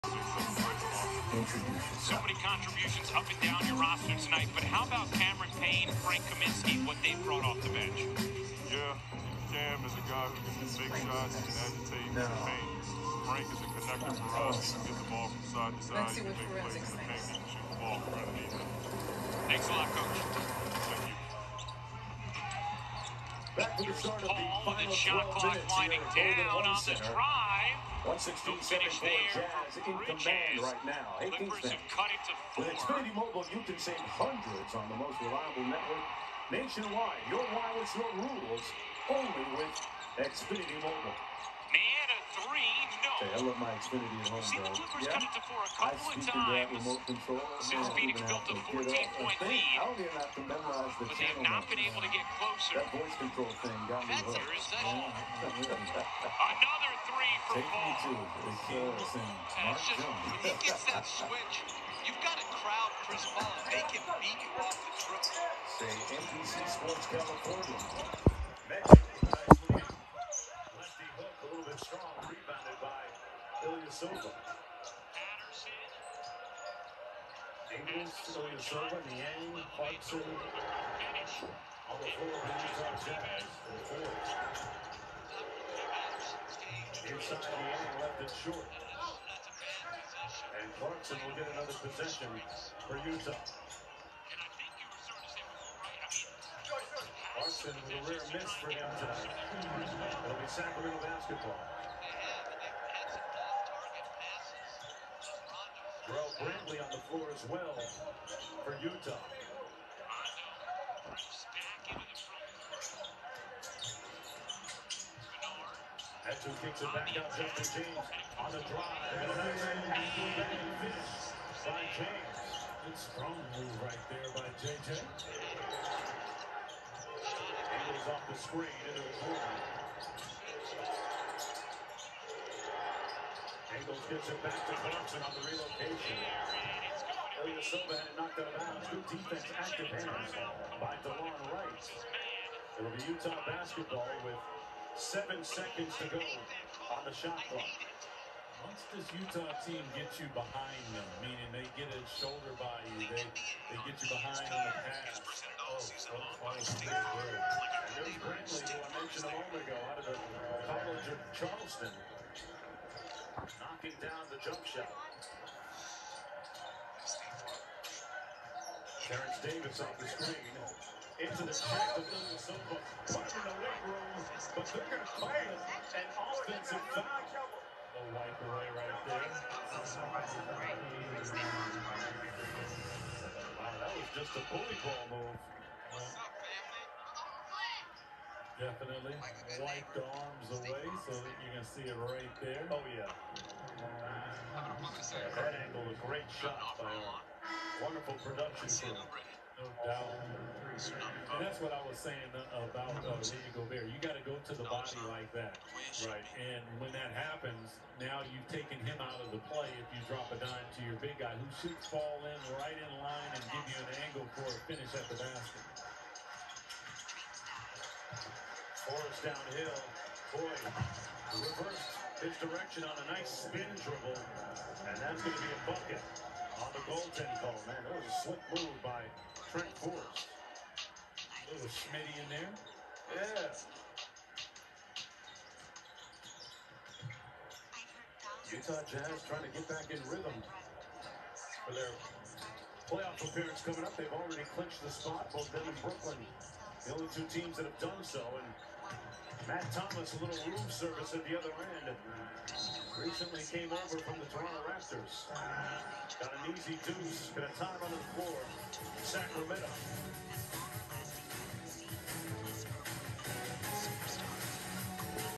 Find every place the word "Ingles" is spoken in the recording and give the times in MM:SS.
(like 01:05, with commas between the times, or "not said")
01:17, 02:07.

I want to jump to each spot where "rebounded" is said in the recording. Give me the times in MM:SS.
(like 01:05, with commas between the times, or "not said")
01:12.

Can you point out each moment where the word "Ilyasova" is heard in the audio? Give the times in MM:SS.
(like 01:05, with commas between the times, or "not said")
01:13, 01:18.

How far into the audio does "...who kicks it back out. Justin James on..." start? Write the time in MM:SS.
01:56.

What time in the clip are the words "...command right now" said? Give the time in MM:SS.
00:29.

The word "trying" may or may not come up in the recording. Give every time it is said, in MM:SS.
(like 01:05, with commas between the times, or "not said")
03:59.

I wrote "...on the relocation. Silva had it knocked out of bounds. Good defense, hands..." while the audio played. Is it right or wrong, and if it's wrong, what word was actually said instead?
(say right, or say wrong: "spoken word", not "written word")
right.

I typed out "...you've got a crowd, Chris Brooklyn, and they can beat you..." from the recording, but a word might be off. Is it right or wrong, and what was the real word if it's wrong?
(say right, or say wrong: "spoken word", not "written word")
wrong: "Paul", not "Brooklyn".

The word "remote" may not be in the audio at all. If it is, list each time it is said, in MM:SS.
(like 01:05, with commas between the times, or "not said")
00:46.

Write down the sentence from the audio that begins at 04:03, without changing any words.
They've already clinched the spot, both them and Brooklyn.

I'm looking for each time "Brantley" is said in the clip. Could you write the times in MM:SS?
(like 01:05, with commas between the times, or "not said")
01:46, 02:36.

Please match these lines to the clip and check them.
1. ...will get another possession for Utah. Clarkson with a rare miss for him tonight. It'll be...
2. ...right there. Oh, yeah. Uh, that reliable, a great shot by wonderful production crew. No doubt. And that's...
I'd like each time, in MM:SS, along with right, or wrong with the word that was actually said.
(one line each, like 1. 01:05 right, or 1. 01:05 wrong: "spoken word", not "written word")
1. 01:31 right
2. 03:12 wrong: "angle", not "reliable".